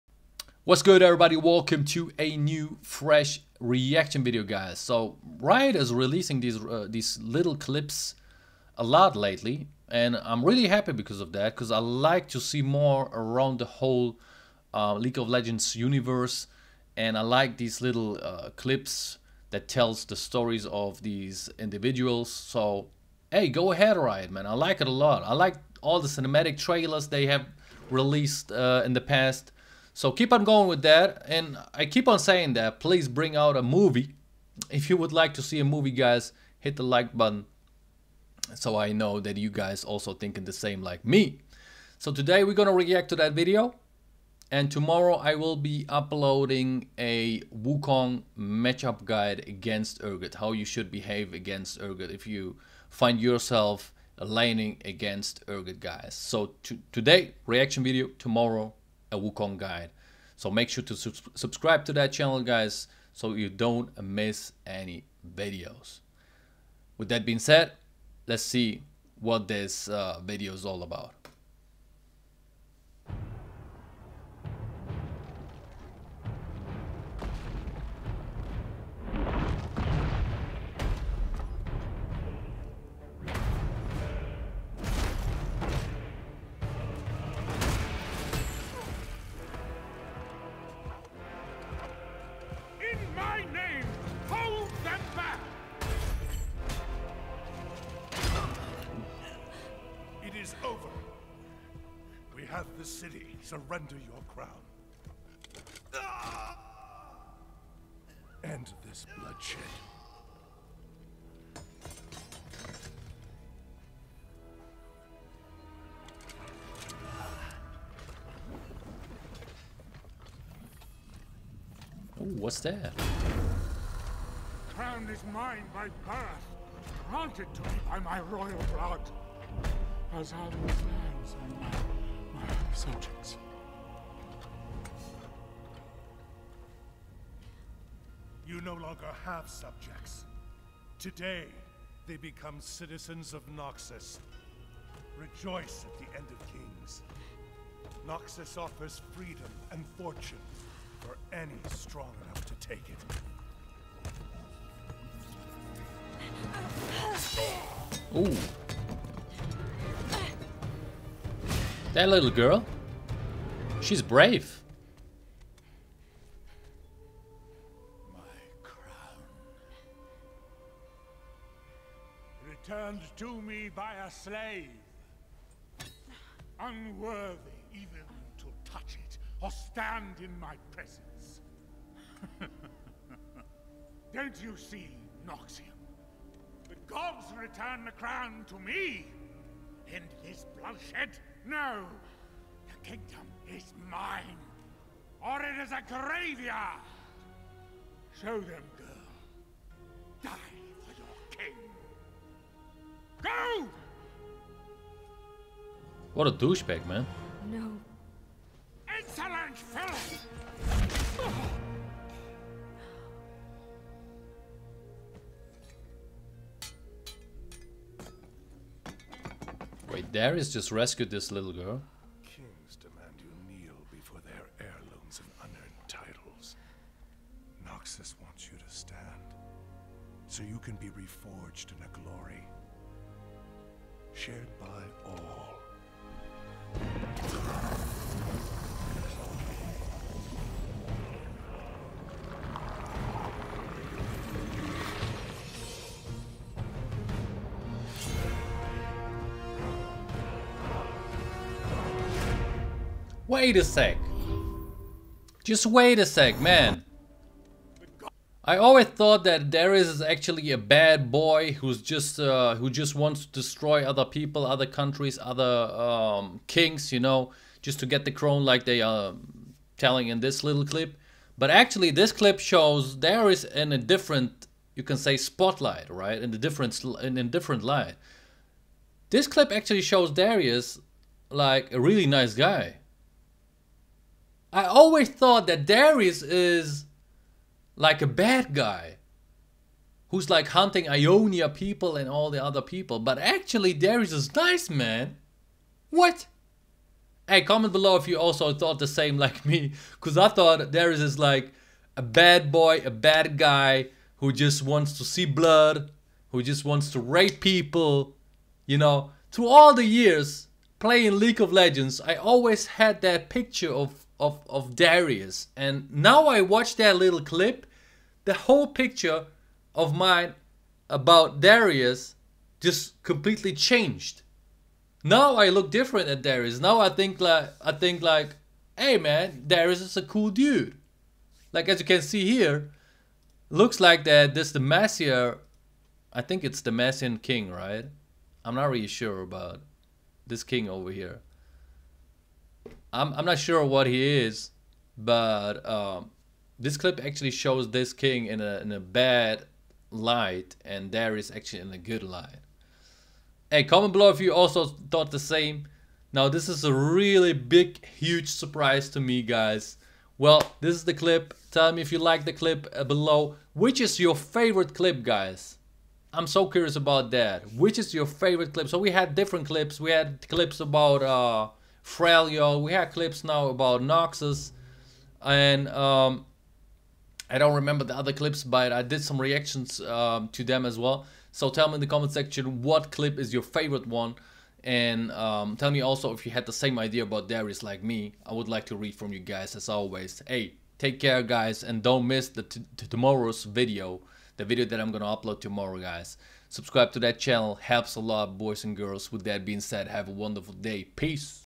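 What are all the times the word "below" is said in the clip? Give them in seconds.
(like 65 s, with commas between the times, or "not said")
297 s, 353 s, 362 s.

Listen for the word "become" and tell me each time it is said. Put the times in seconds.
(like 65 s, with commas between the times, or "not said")
142 s.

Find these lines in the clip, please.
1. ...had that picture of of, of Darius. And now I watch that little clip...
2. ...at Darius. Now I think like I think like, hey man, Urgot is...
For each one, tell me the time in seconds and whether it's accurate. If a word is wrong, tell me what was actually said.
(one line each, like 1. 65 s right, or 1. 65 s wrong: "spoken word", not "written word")
1. 312 s right
2. 326 s wrong: "Darius", not "Urgot".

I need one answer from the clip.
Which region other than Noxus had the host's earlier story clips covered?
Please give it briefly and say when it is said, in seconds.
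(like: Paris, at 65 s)
Freljord, at 371 s.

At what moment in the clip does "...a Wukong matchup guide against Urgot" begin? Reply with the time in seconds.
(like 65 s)
46 s.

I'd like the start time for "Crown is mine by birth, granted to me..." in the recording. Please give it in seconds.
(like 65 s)
124 s.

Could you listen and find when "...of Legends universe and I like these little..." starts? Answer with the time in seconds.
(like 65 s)
15 s.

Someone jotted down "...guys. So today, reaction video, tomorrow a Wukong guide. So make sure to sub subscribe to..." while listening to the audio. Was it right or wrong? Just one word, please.
right.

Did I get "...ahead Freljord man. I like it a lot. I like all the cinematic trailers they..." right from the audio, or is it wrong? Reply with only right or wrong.
wrong.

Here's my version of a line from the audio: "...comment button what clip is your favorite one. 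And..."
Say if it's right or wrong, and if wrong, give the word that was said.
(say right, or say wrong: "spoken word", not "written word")
wrong: "section", not "button".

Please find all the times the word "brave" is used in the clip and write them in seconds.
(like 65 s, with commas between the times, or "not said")
164 s.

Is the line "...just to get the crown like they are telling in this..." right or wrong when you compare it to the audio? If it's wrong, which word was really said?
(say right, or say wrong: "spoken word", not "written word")
right.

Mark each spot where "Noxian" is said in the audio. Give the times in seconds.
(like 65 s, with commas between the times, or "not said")
185 s.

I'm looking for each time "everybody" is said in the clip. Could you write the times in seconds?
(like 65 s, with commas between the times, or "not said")
1 s.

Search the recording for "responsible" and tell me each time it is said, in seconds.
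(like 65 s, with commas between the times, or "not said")
not said.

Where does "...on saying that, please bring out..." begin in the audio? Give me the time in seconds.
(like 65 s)
32 s.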